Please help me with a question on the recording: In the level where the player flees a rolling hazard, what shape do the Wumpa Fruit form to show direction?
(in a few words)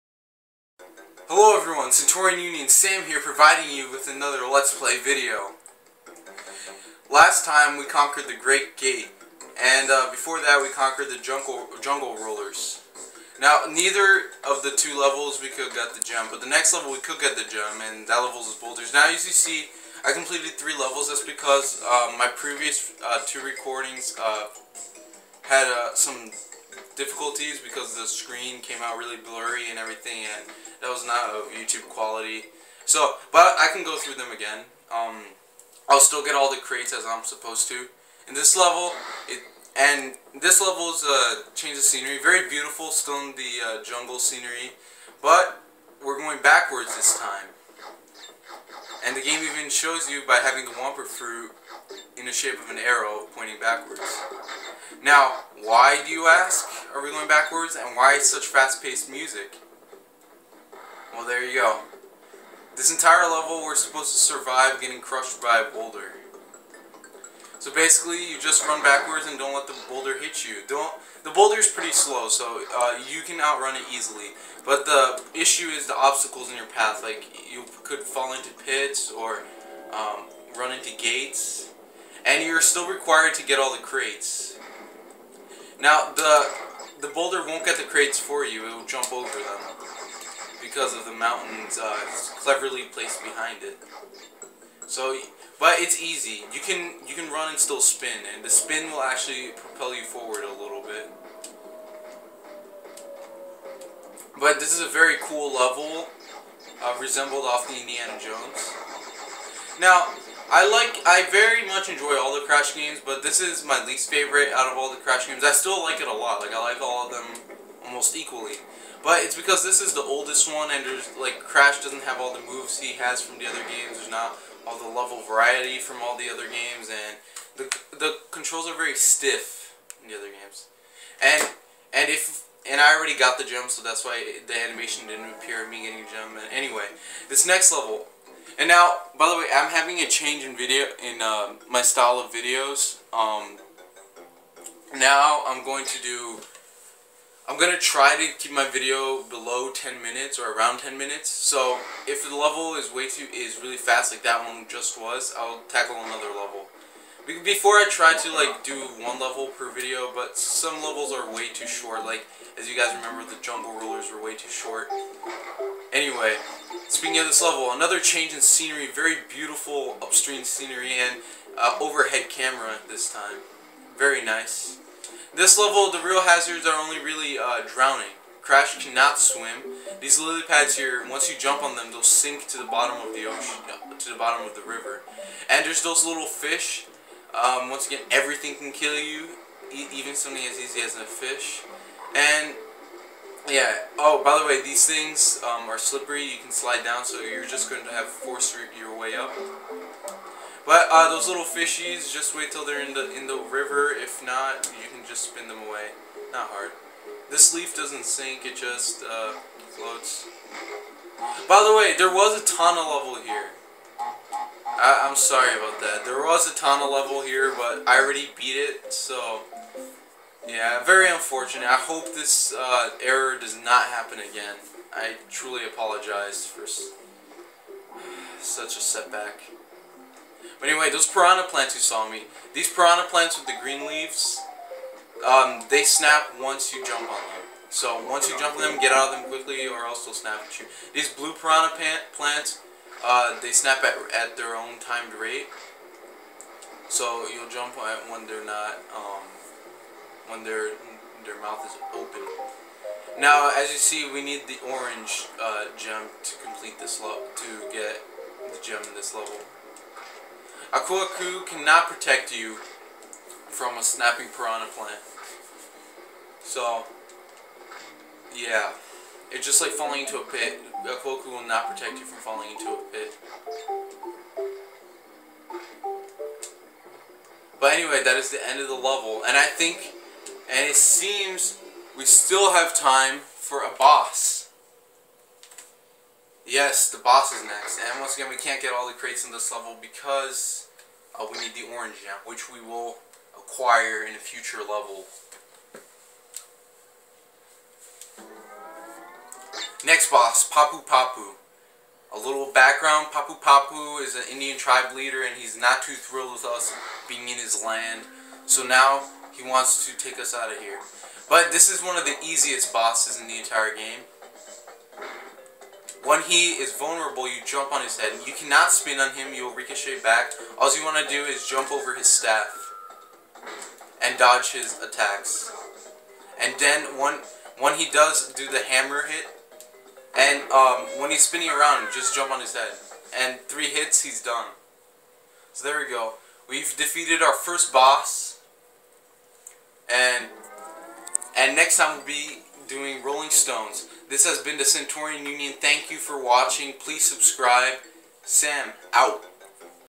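an arrow.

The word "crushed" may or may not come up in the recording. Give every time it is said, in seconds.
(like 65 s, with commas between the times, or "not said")
65 s.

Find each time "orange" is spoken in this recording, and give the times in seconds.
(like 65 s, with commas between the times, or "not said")
254 s, 291 s.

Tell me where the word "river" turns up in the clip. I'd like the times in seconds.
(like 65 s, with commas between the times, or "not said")
184 s, 203 s.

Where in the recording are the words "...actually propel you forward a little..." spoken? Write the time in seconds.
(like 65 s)
99 s.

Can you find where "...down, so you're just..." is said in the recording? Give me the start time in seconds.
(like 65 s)
196 s.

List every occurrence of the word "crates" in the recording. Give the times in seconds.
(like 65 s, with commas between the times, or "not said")
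36 s, 83 s, 87 s, 288 s.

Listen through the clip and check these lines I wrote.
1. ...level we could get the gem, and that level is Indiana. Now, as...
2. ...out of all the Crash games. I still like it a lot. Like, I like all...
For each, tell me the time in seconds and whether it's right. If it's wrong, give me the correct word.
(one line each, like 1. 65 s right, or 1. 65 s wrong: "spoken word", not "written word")
1. 16 s wrong: "Boulders", not "Indiana"
2. 114 s right.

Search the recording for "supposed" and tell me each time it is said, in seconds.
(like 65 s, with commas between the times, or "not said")
37 s, 63 s.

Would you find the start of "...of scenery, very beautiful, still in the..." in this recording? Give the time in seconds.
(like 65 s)
41 s.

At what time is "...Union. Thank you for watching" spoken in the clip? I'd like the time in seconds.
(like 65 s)
345 s.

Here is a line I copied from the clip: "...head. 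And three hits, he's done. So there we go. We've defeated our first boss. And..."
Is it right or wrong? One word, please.
right.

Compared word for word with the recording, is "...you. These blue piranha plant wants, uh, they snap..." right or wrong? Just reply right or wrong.
wrong.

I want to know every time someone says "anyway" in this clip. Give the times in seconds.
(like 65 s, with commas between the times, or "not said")
136 s, 165 s, 230 s, 277 s.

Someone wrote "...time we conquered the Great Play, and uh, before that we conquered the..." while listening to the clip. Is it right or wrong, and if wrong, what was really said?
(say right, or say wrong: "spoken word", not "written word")
wrong: "Gate", not "Play".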